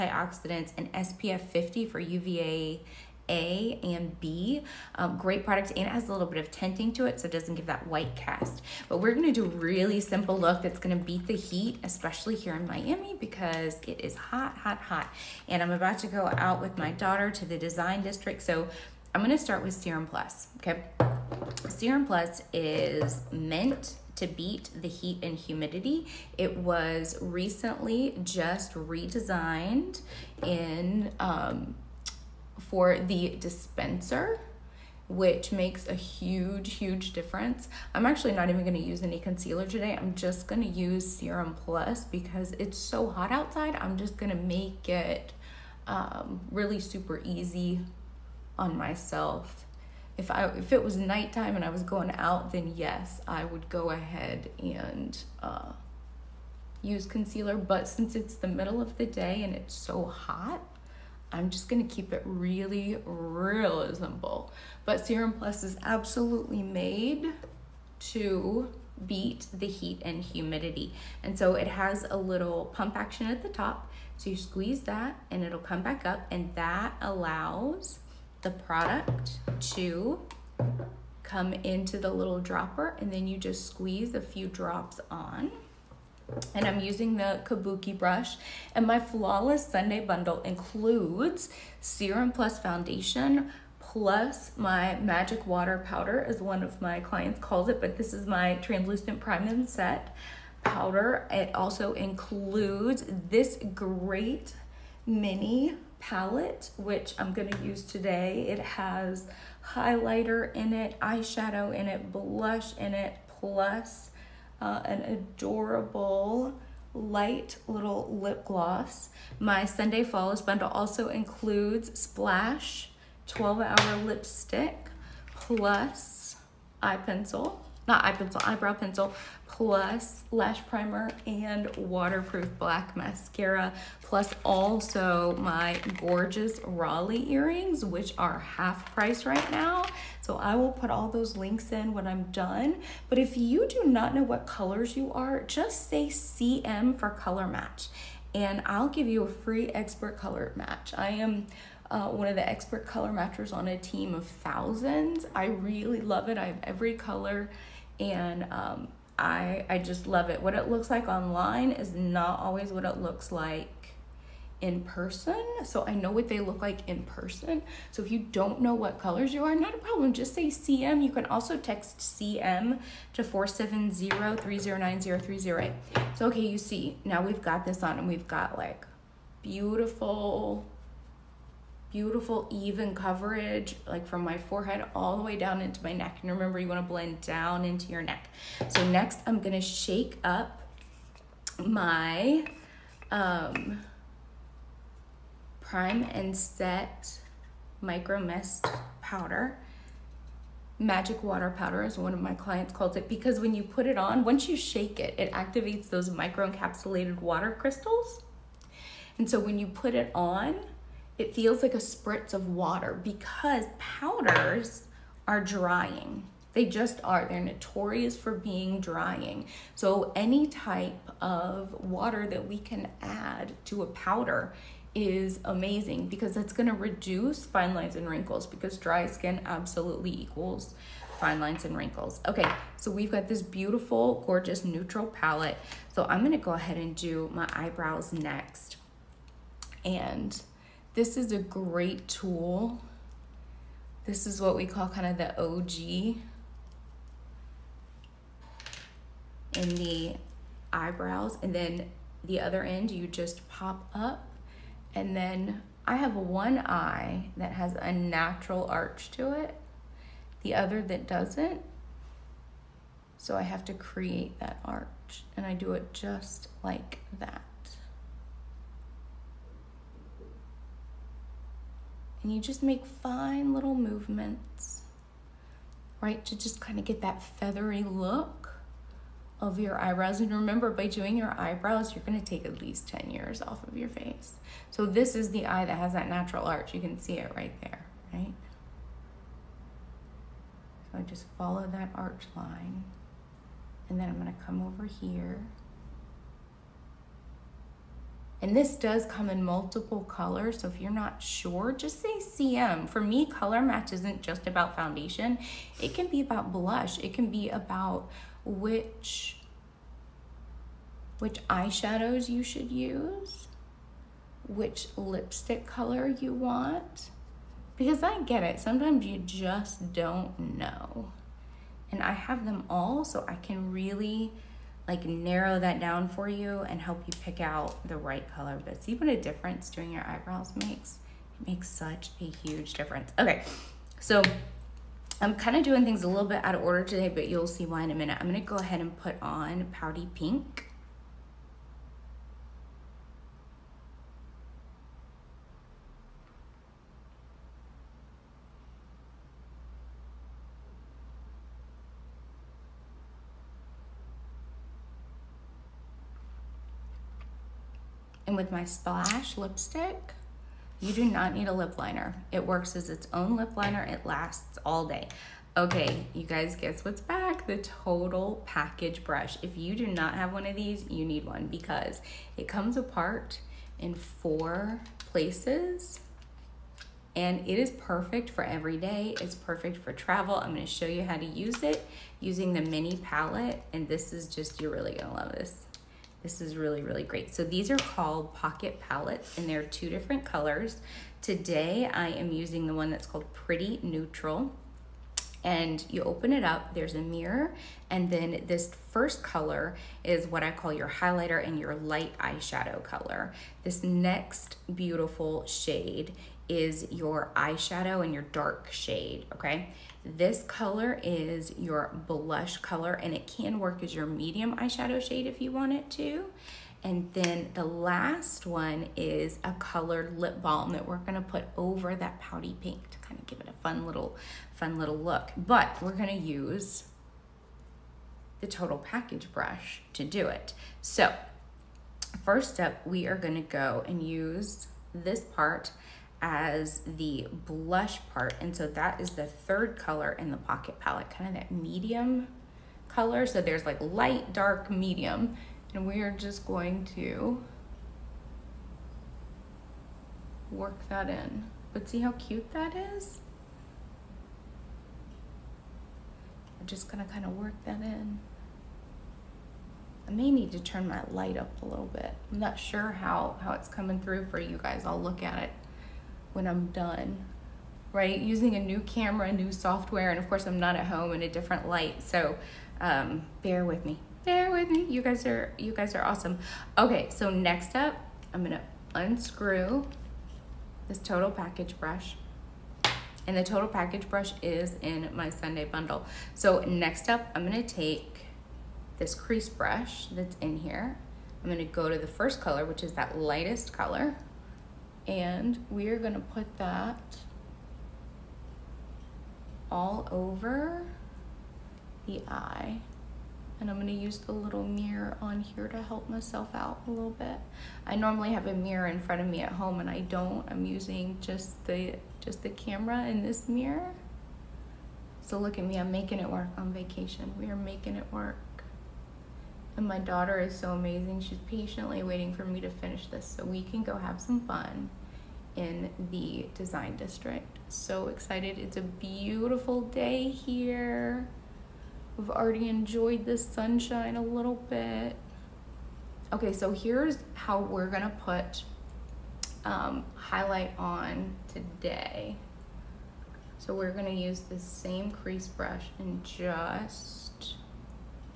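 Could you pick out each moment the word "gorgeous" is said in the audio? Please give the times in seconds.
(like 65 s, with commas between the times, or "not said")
135 s, 234 s.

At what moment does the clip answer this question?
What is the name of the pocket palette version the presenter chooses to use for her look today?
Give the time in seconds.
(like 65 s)
393 s.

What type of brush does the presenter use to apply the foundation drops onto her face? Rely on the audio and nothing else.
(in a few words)
Kabuki brush.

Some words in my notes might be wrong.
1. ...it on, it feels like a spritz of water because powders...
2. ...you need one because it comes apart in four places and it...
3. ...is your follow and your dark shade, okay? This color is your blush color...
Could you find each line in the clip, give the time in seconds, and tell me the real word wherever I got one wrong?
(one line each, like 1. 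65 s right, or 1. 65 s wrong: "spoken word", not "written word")
1. 209 s right
2. 370 s right
3. 406 s wrong: "eyeshadow", not "follow".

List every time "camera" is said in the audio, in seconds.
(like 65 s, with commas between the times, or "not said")
468 s, 512 s.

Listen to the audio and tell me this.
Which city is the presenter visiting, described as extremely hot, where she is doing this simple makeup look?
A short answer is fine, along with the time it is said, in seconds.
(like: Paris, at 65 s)
Miami, at 12 s.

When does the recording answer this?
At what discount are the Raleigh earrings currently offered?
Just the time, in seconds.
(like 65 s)
138 s.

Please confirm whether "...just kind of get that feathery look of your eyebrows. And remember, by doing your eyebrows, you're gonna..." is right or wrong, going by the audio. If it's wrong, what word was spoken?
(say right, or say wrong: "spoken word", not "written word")
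right.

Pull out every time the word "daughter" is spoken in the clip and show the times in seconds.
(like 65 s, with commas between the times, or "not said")
16 s, 519 s.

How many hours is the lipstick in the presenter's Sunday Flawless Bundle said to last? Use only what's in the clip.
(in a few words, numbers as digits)
12.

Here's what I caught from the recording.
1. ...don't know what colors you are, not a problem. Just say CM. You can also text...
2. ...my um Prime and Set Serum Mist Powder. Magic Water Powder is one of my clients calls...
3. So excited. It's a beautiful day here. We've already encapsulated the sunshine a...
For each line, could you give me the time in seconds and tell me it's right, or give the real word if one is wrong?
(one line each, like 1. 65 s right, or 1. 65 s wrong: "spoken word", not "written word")
1. 168 s right
2. 191 s wrong: "Micro", not "Serum"
3. 527 s wrong: "enjoyed", not "encapsulated".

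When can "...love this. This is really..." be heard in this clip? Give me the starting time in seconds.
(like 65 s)
385 s.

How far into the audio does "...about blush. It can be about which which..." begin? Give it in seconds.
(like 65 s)
306 s.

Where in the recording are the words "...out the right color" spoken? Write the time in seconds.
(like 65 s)
327 s.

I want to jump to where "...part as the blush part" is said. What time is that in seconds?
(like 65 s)
435 s.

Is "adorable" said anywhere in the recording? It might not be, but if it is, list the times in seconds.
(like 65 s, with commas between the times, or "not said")
115 s.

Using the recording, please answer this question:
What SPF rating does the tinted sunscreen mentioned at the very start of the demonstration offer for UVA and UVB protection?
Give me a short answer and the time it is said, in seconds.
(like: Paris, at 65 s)
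SPF 50, at 0 s.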